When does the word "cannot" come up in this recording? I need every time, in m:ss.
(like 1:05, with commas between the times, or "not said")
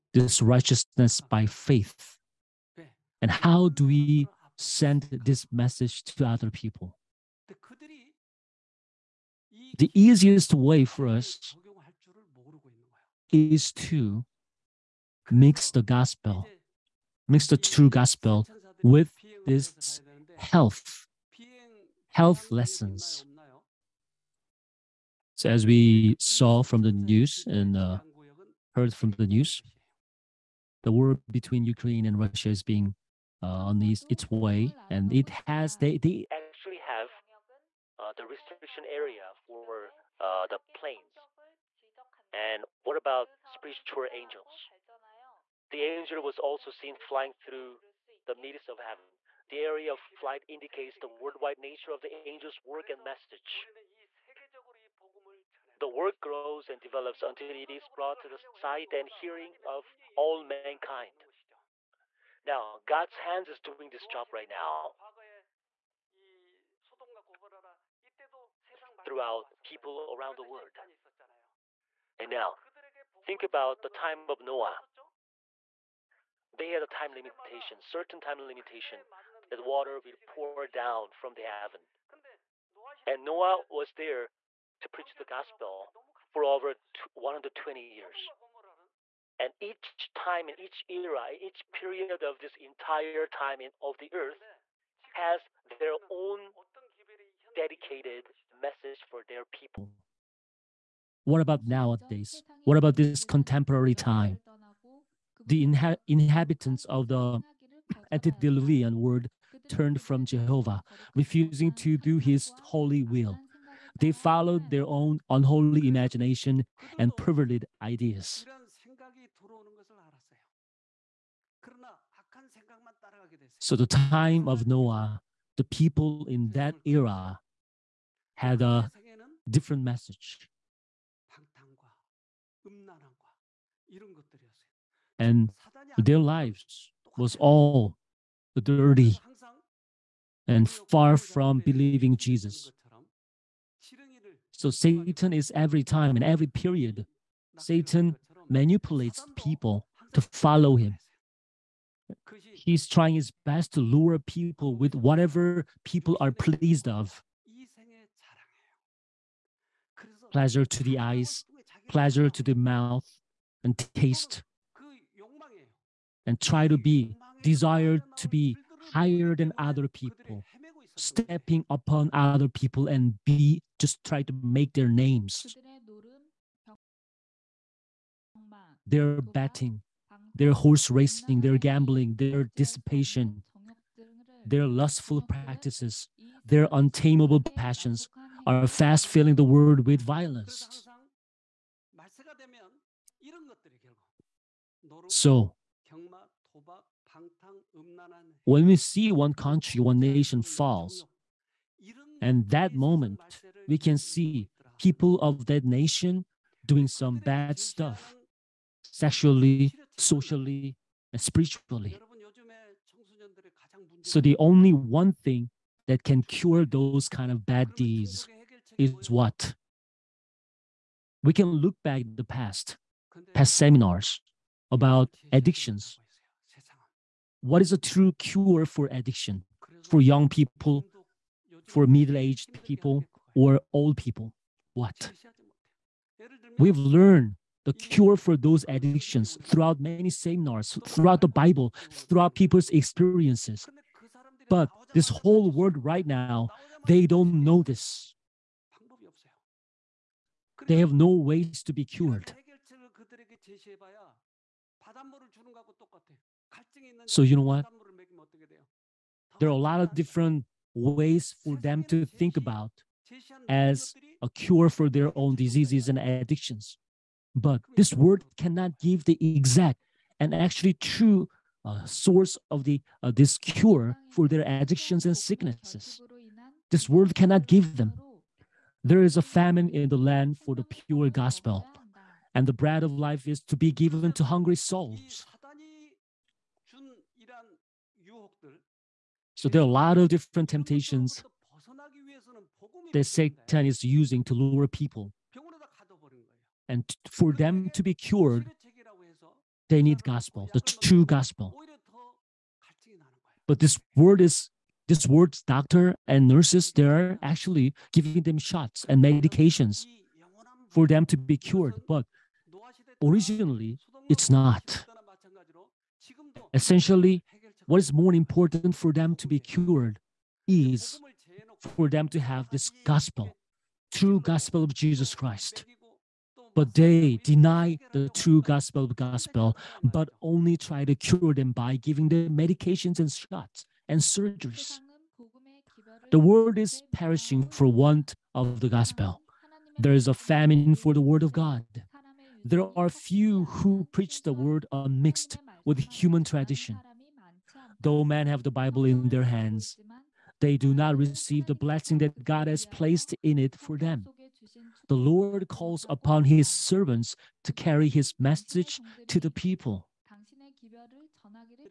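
4:28, 4:37.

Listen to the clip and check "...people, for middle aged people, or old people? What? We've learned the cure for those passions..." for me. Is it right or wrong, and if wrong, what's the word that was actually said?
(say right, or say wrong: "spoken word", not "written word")
wrong: "addictions", not "passions".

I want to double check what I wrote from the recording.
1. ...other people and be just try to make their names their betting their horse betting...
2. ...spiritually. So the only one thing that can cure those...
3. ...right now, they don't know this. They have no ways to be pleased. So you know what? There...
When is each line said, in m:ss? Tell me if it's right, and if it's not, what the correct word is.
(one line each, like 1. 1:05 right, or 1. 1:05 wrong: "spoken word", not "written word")
1. 2:52 wrong: "racing", not "betting"
2. 3:31 right
3. 4:05 wrong: "cured", not "pleased".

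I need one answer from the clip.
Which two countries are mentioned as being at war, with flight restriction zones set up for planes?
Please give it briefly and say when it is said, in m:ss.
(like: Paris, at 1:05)
Ukraine and Russia, at 0:31.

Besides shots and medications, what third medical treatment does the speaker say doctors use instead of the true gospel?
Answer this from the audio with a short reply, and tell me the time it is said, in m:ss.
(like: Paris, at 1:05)
surgeries, at 5:34.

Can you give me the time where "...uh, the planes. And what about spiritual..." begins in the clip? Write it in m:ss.
0:40.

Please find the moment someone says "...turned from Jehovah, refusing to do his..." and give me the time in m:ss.
1:49.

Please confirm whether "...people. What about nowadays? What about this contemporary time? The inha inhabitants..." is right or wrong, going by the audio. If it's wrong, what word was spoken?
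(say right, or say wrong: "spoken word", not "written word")
right.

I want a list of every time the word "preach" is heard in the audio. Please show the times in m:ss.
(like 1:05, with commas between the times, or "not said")
1:24, 5:43.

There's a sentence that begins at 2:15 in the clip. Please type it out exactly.
And their lives was all dirty and far from believing Jesus.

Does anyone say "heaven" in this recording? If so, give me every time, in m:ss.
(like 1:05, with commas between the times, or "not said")
0:48, 1:21.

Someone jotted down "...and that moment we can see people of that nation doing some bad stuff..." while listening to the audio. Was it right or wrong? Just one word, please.
right.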